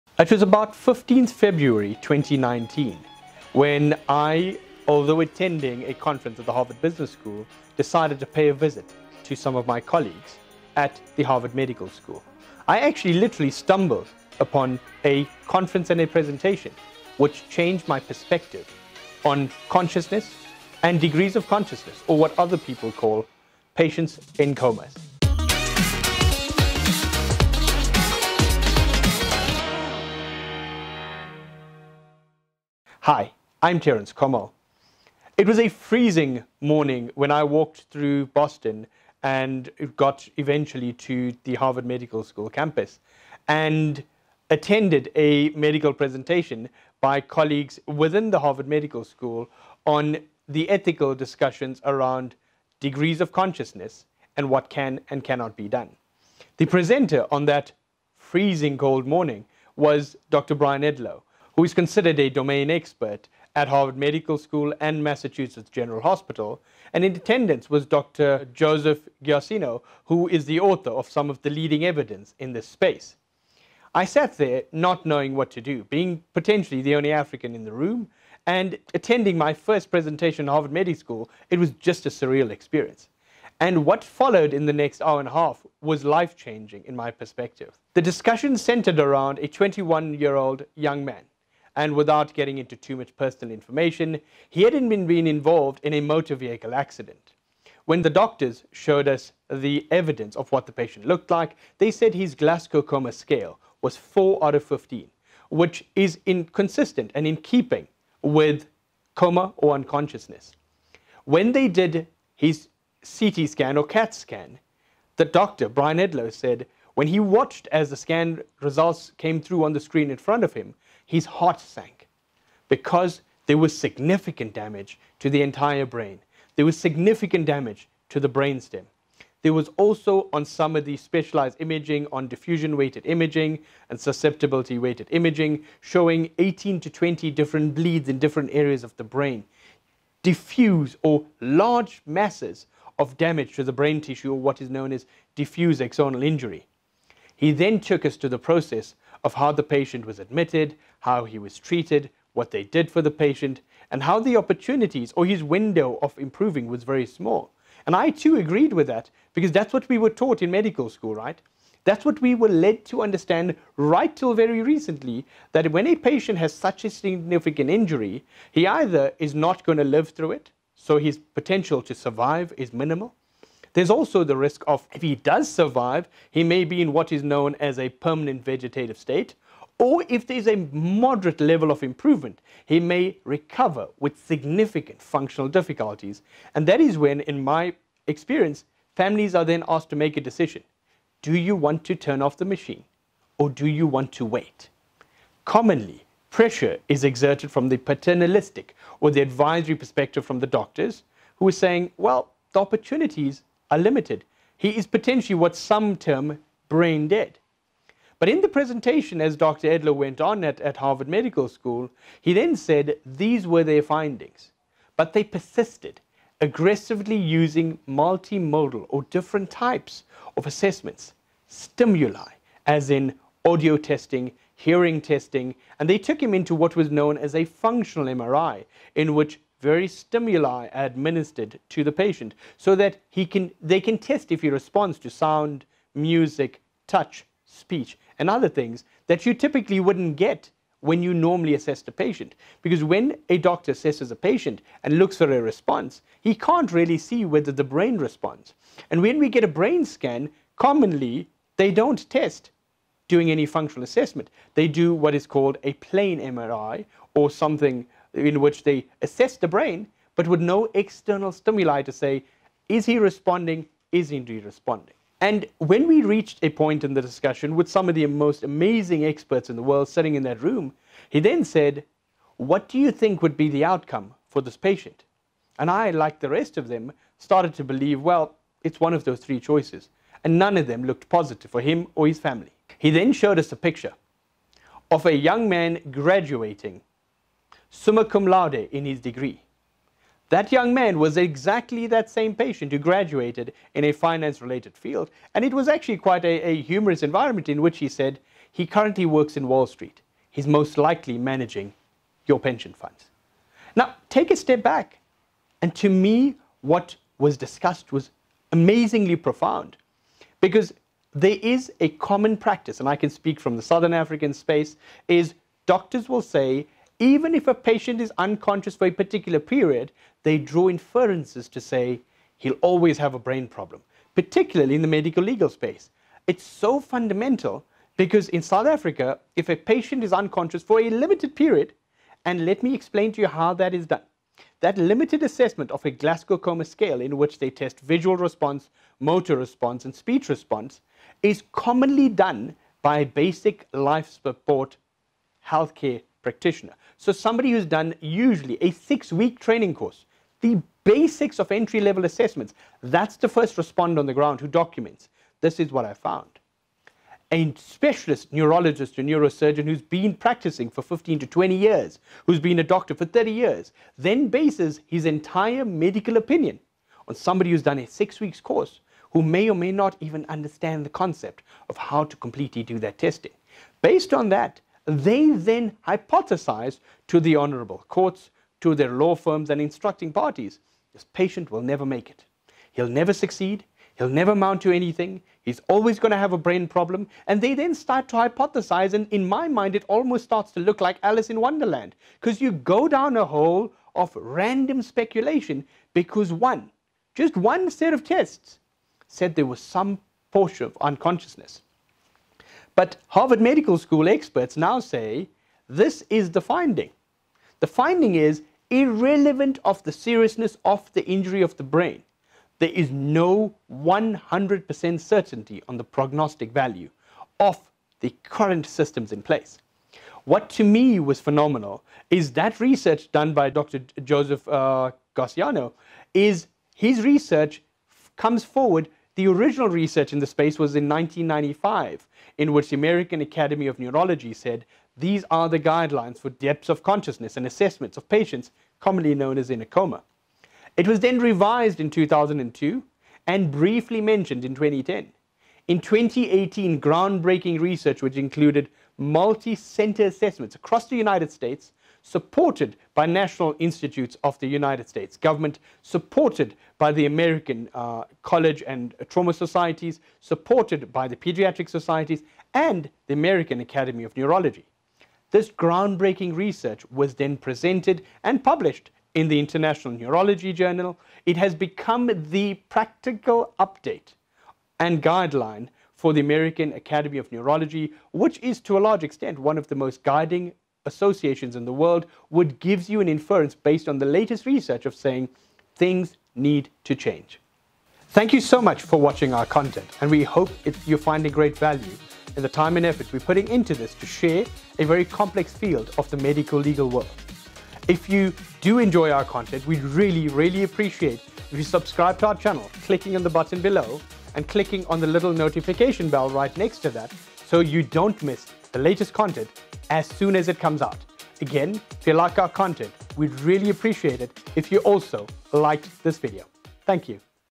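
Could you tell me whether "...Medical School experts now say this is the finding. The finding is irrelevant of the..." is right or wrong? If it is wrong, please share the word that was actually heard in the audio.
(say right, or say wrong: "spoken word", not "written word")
right.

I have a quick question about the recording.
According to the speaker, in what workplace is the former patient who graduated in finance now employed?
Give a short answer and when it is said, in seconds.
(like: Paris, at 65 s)
Wall Street, at 299 s.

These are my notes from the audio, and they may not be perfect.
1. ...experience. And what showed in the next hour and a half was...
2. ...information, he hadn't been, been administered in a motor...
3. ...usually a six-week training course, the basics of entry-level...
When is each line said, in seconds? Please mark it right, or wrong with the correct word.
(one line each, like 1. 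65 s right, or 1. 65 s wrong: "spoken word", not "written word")
1. 82 s wrong: "followed", not "showed"
2. 93 s wrong: "involved", not "administered"
3. 347 s right.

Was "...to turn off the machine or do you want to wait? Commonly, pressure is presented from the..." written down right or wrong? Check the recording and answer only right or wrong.
wrong.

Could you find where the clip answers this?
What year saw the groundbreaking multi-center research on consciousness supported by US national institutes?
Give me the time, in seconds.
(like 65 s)
445 s.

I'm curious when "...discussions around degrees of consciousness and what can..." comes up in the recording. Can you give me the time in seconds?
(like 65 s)
51 s.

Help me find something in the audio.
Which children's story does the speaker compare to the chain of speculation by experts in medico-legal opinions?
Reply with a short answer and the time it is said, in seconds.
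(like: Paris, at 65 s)
Alice in Wonderland, at 391 s.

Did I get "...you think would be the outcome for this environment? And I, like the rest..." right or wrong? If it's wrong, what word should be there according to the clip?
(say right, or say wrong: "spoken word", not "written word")
wrong: "patient", not "environment".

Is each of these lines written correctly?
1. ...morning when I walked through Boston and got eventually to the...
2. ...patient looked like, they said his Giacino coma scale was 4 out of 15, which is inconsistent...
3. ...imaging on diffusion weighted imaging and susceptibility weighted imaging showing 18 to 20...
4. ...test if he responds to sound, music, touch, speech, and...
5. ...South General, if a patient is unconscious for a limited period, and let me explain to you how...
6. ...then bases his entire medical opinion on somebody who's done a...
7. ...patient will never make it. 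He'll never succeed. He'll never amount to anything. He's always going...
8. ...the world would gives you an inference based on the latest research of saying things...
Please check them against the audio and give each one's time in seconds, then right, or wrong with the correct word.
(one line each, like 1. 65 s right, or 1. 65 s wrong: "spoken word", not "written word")
1. 36 s right
2. 100 s wrong: "Glasgow", not "Giacino"
3. 131 s right
4. 233 s right
5. 328 s wrong: "Africa", not "General"
6. 363 s right
7. 381 s right
8. 481 s right.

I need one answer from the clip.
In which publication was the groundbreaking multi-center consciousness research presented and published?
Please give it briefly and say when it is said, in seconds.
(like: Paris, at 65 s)
International Neurology Journal, at 469 s.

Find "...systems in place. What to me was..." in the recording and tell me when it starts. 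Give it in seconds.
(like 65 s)
418 s.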